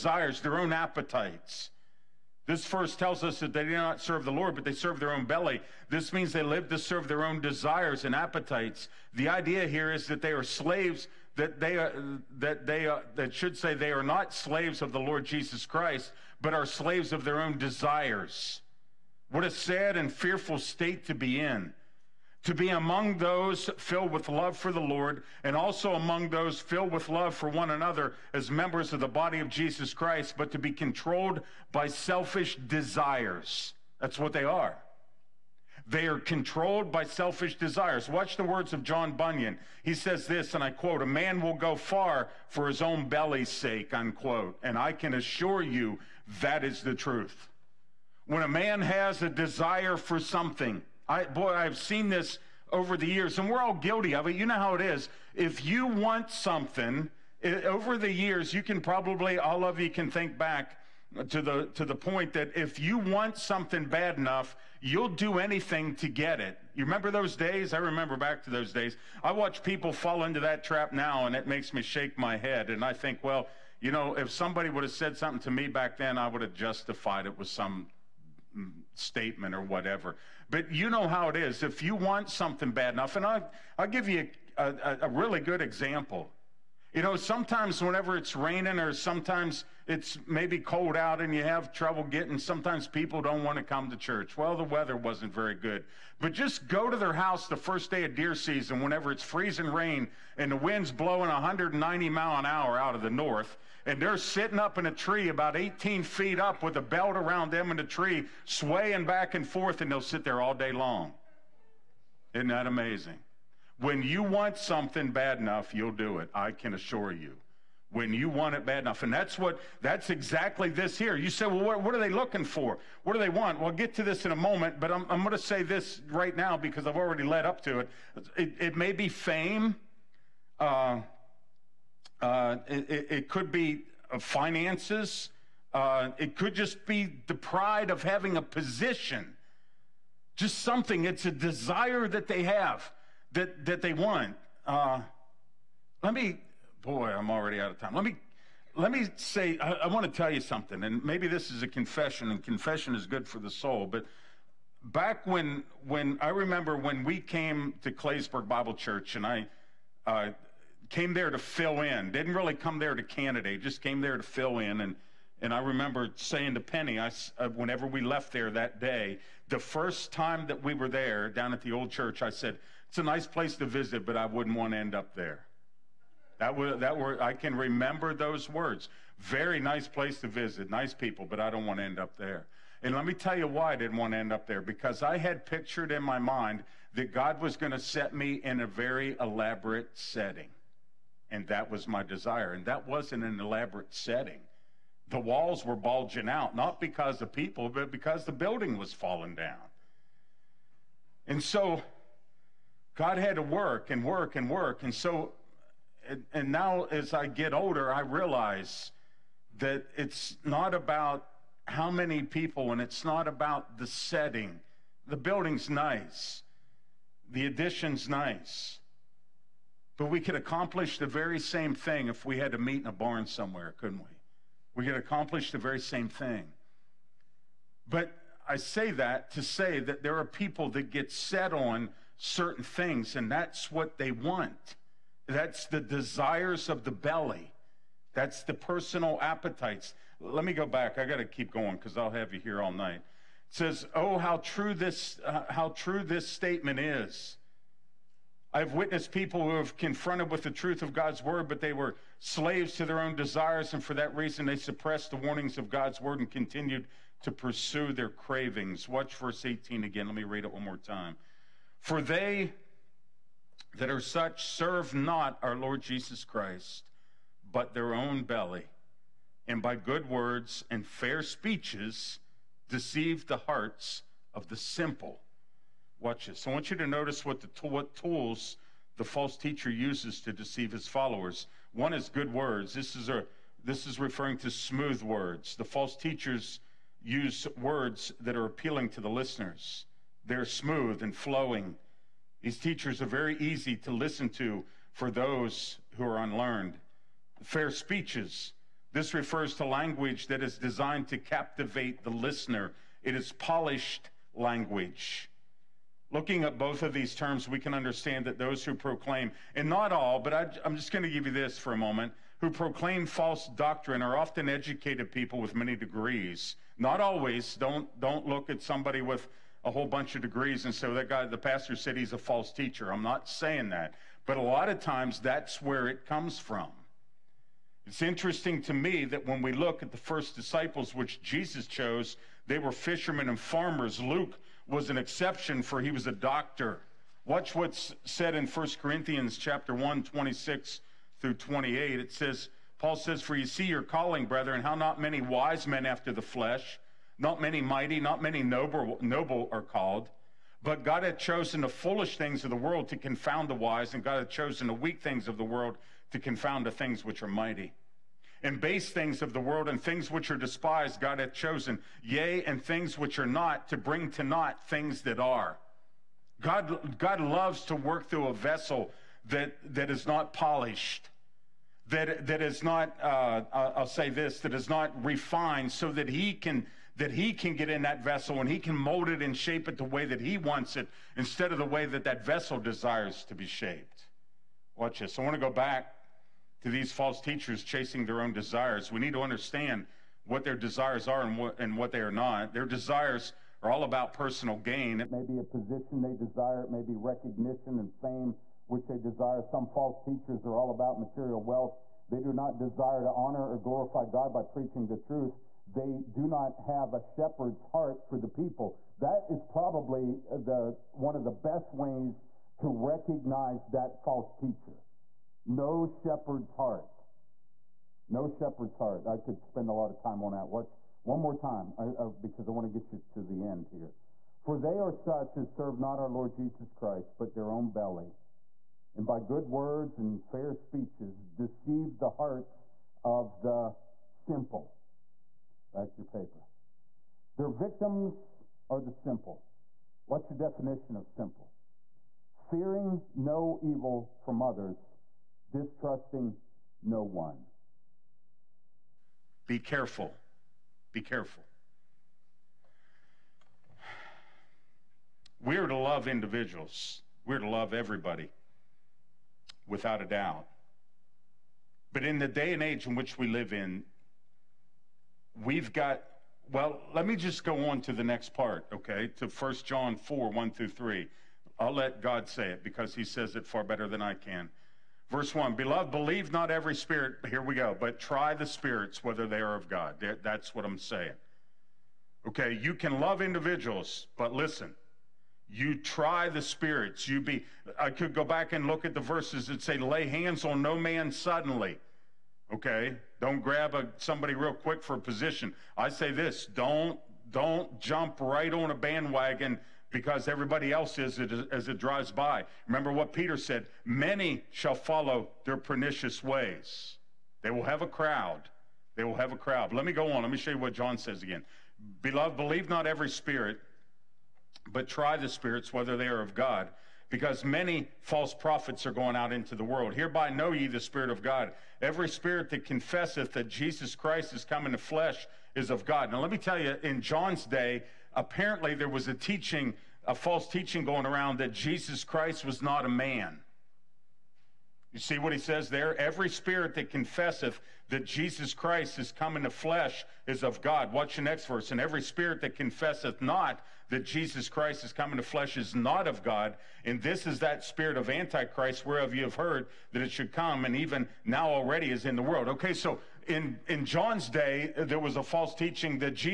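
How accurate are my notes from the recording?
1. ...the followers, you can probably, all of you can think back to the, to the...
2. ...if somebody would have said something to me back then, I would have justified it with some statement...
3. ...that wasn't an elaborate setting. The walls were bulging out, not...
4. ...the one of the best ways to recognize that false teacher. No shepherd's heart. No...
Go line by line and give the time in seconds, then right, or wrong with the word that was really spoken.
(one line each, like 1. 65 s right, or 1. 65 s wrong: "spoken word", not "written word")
1. 57 s wrong: "years", not "followers"
2. 74 s right
3. 192 s right
4. 410 s right.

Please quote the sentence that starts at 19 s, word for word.
What a sad and fearful state to be in.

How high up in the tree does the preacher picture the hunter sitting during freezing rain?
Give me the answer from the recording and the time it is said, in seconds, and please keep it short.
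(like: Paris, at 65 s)
18 feet, at 105 s.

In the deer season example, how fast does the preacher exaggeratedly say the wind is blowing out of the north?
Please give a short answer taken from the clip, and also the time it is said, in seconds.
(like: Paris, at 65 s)
190 mile an hour, at 101 s.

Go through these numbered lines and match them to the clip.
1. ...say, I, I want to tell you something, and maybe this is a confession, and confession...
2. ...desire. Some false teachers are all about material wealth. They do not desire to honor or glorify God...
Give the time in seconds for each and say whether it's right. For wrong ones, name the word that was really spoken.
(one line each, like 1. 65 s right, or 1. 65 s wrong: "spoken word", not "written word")
1. 149 s right
2. 398 s right.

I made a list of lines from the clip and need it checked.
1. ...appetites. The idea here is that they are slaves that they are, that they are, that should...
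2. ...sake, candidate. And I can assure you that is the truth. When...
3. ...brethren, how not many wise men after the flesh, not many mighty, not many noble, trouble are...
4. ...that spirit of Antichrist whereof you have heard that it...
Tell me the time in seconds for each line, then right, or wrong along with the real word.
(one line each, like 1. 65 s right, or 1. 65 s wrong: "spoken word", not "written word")
1. 8 s right
2. 43 s wrong: "unquote", not "candidate"
3. 344 s wrong: "noble", not "trouble"
4. 547 s right.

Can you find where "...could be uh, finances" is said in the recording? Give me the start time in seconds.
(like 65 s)
133 s.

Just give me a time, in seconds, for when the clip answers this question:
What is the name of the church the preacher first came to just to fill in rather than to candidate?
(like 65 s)
157 s.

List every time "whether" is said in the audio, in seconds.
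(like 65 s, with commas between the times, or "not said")
479 s, 515 s.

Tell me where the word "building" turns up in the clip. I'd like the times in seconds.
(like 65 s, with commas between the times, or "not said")
198 s, 215 s.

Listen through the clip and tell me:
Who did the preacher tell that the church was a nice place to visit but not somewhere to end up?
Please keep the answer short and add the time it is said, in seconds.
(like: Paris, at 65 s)
Penny, at 166 s.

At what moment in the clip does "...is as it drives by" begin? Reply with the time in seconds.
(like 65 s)
500 s.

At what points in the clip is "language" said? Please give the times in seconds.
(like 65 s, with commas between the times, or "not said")
299 s, 304 s.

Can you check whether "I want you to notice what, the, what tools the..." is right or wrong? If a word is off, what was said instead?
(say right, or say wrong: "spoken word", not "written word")
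right.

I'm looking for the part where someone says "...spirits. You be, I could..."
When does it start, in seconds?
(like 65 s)
486 s.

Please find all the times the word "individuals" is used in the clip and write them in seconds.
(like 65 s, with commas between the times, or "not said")
456 s, 483 s.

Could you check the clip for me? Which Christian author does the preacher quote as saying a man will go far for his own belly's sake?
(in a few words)
John Bunyan.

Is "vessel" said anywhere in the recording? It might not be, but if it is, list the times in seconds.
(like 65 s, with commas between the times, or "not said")
368 s, 378 s, 382 s.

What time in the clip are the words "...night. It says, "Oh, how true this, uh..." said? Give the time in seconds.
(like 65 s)
242 s.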